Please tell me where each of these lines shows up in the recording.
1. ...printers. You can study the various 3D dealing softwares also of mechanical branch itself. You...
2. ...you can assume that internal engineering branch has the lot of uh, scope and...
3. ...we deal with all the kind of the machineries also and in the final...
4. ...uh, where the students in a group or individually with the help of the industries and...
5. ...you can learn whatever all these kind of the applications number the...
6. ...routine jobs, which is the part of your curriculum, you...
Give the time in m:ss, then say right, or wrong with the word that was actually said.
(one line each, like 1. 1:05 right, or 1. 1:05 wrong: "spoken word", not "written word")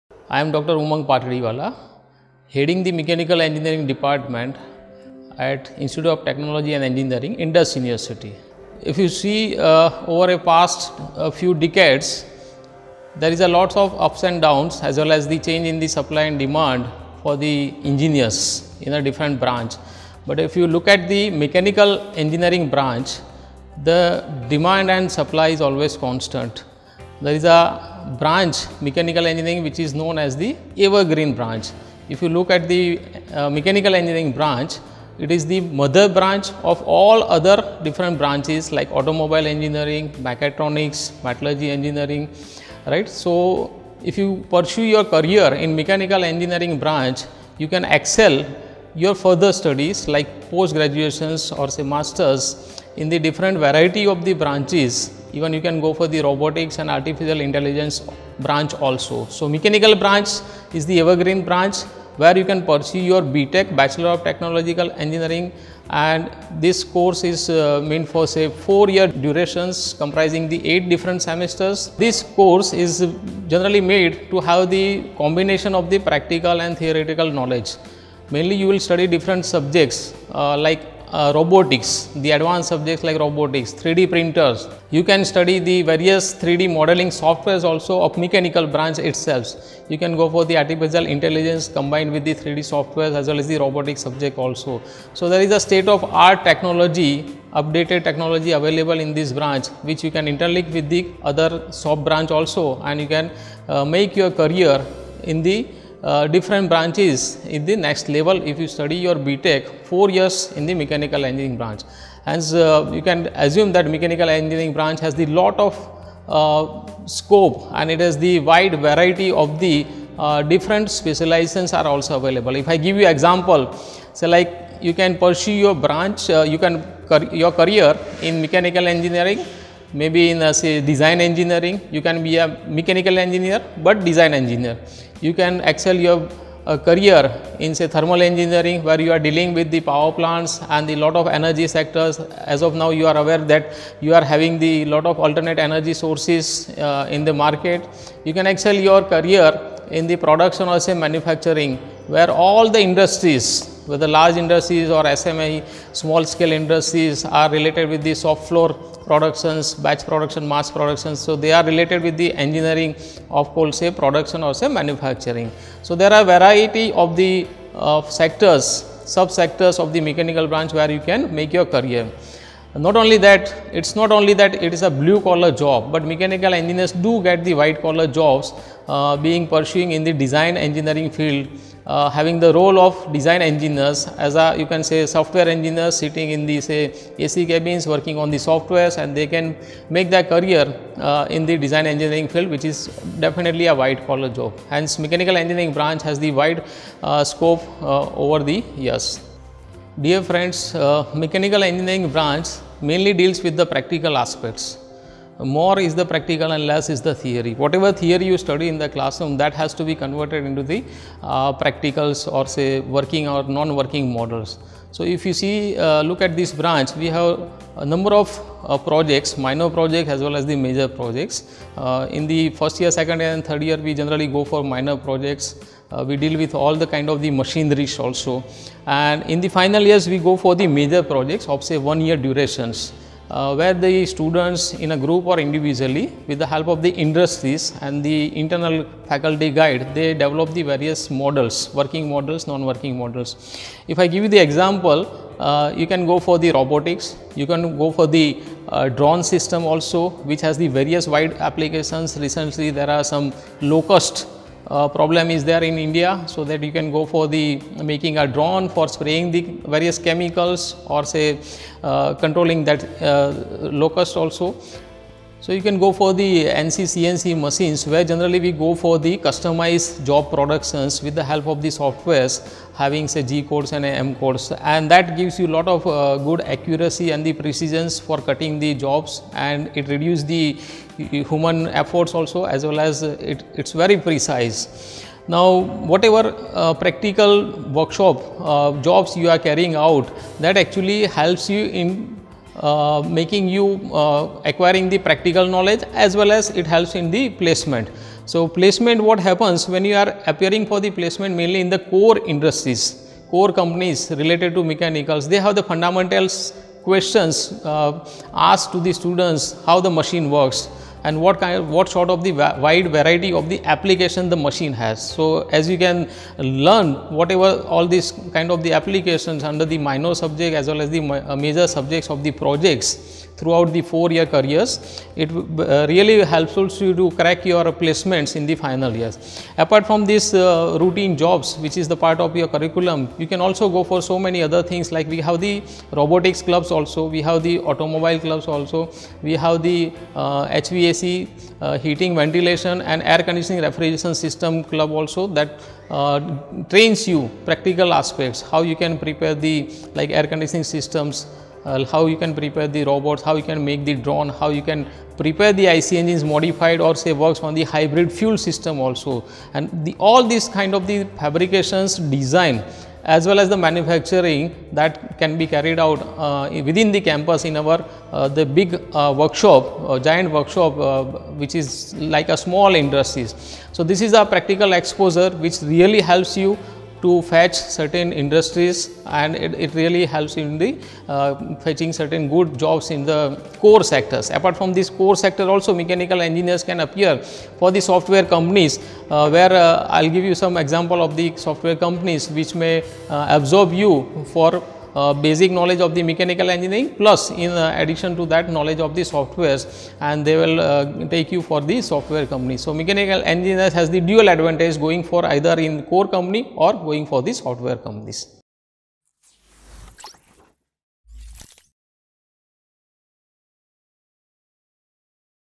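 1. 1:24 wrong: "modeling", not "dealing"
2. 1:52 wrong: "mechanical", not "internal"
3. 3:46 right
4. 3:53 right
5. 5:15 wrong: "under", not "number"
6. 5:30 right.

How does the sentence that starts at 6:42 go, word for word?
So, mechanical engineers has the dual advantage going for either in core company or going for the software companies.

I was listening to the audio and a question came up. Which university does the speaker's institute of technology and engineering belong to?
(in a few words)
Indus University.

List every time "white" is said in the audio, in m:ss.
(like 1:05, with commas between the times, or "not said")
2:57, 3:13.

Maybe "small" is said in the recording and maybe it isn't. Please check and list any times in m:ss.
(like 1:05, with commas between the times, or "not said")
2:36, 6:12.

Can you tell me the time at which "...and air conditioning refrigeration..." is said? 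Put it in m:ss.
5:42.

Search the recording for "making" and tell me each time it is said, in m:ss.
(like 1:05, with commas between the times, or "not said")
4:17, 4:53.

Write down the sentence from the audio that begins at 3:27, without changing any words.
Whatever theory you study in the classroom that has to be converted into the uh, practicals or say working or non-working models.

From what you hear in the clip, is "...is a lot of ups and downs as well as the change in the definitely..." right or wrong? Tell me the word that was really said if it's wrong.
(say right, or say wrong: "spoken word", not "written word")
wrong: "supply", not "definitely".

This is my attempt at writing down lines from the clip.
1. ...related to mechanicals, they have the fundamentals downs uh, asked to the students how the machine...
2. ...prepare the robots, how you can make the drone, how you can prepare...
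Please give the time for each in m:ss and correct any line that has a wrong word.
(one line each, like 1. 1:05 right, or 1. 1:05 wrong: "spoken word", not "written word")
1. 5:04 wrong: "questions", not "downs"
2. 5:52 right.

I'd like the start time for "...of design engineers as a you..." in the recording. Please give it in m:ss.
3:02.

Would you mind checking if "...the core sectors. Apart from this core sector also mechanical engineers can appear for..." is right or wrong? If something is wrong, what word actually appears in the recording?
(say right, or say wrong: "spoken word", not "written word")
right.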